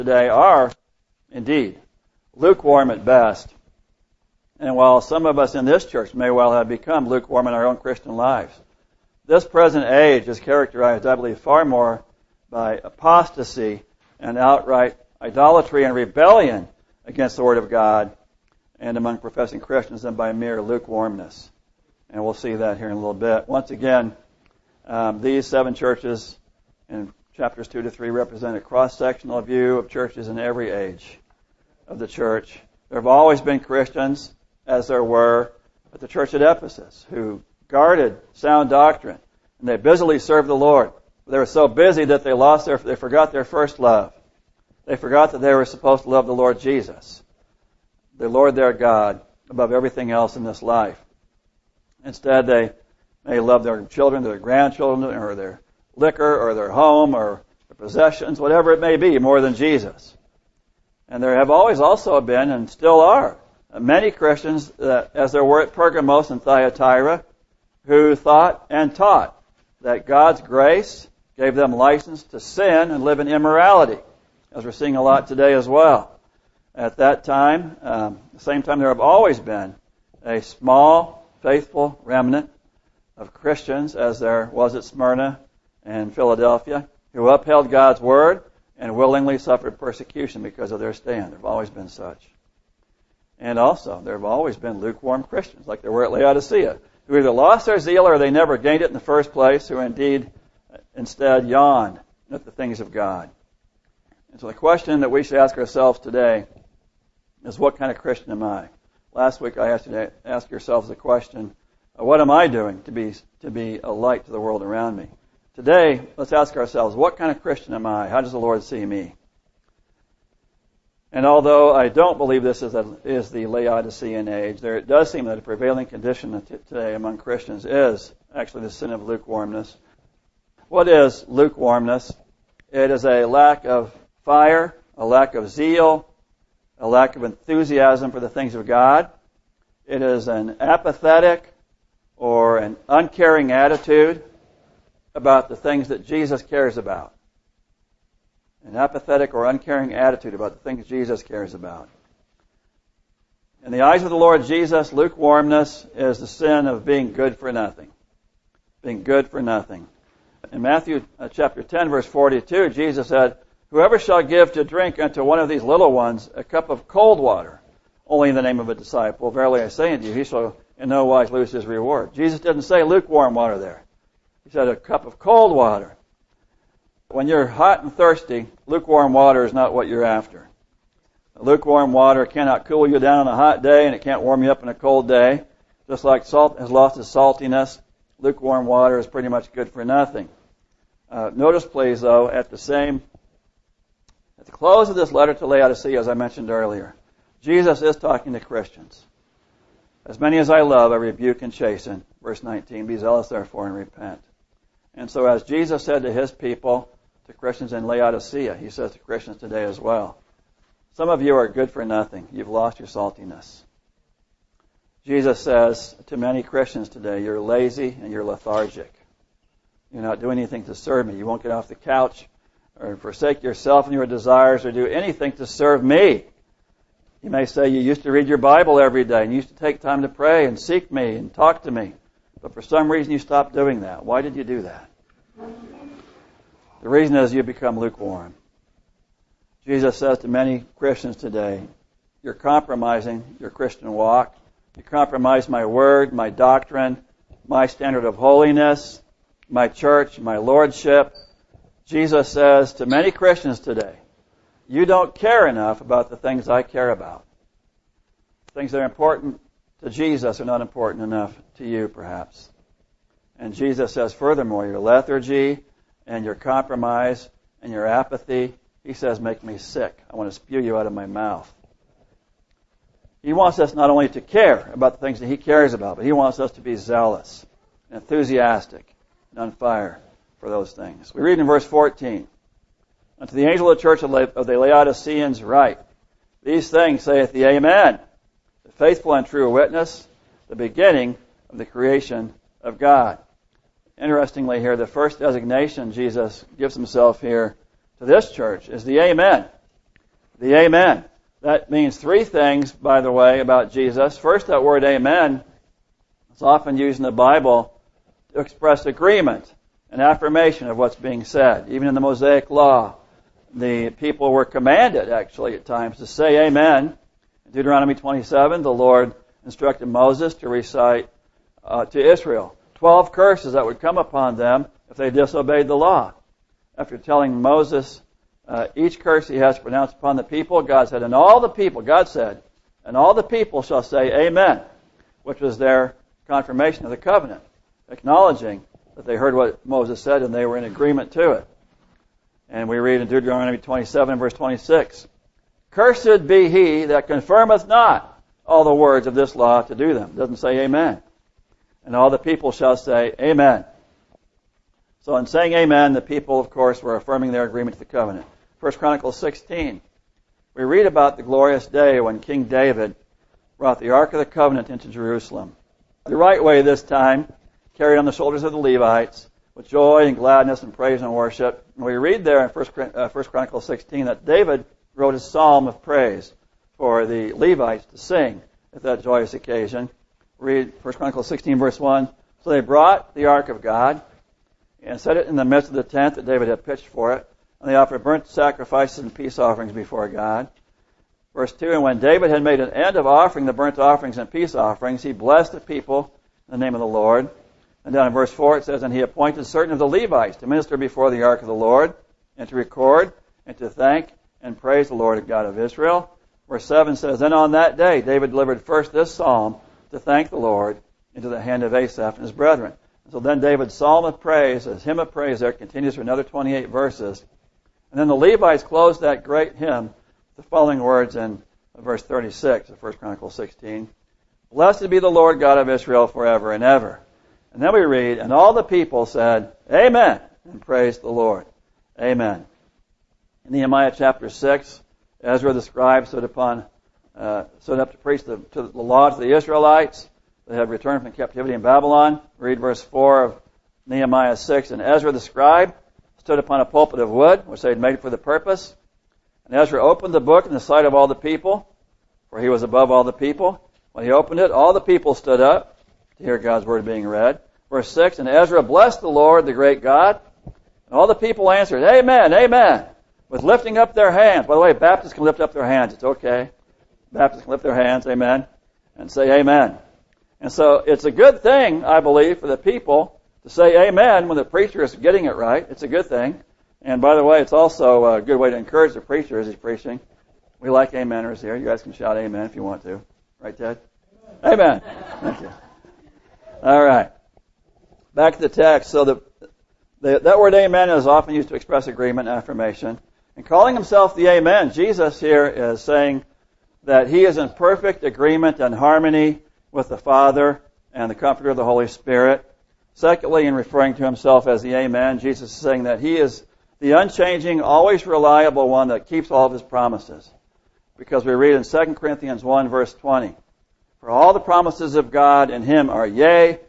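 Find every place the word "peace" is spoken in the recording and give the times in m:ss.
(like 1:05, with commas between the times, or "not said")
6:29, 6:34.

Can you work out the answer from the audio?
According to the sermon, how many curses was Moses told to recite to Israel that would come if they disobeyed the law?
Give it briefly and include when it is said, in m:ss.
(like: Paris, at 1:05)
12, at 5:22.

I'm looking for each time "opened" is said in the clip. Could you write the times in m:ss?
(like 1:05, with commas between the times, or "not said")
7:29, 7:34.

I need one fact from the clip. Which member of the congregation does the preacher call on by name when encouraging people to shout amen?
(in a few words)
Ted.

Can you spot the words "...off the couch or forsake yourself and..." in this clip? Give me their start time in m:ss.
3:41.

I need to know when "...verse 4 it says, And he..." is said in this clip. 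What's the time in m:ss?
6:38.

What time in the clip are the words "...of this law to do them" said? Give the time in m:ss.
5:49.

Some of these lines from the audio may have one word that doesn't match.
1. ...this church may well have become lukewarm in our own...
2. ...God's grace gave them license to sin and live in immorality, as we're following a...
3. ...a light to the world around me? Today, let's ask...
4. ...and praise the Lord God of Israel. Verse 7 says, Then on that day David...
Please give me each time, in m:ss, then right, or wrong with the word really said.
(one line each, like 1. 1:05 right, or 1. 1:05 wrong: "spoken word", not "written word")
1. 0:05 right
2. 1:10 wrong: "seeing", not "following"
3. 1:53 right
4. 6:44 right.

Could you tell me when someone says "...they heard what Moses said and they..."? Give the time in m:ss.
5:39.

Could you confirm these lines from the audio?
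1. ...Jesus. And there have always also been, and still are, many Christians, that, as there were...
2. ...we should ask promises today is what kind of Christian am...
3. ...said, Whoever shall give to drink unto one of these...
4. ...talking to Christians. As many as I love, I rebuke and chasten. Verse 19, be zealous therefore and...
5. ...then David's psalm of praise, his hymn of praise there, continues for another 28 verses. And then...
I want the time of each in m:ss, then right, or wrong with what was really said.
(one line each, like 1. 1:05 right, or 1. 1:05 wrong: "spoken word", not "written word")
1. 0:59 right
2. 1:45 wrong: "ourselves", not "promises"
3. 2:43 right
4. 3:17 right
5. 6:53 right.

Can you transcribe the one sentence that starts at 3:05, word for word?
Just like salt has lost its saltiness, lukewarm water is pretty much good for nothing.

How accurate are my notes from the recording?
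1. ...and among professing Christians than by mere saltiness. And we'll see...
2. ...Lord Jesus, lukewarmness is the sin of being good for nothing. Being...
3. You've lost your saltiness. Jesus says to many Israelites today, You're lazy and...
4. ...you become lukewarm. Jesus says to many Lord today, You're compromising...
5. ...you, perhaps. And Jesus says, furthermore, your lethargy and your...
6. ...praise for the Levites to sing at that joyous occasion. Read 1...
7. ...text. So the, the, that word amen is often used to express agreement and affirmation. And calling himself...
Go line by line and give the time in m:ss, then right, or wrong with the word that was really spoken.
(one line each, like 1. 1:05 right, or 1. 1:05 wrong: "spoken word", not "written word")
1. 0:18 wrong: "lukewarmness", not "saltiness"
2. 2:34 right
3. 3:32 wrong: "Christians", not "Israelites"
4. 3:57 wrong: "Christians", not "Lord"
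5. 4:21 right
6. 6:15 right
7. 8:08 right.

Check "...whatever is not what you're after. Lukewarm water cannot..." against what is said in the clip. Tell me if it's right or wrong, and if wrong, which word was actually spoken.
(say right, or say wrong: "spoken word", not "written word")
wrong: "water", not "whatever".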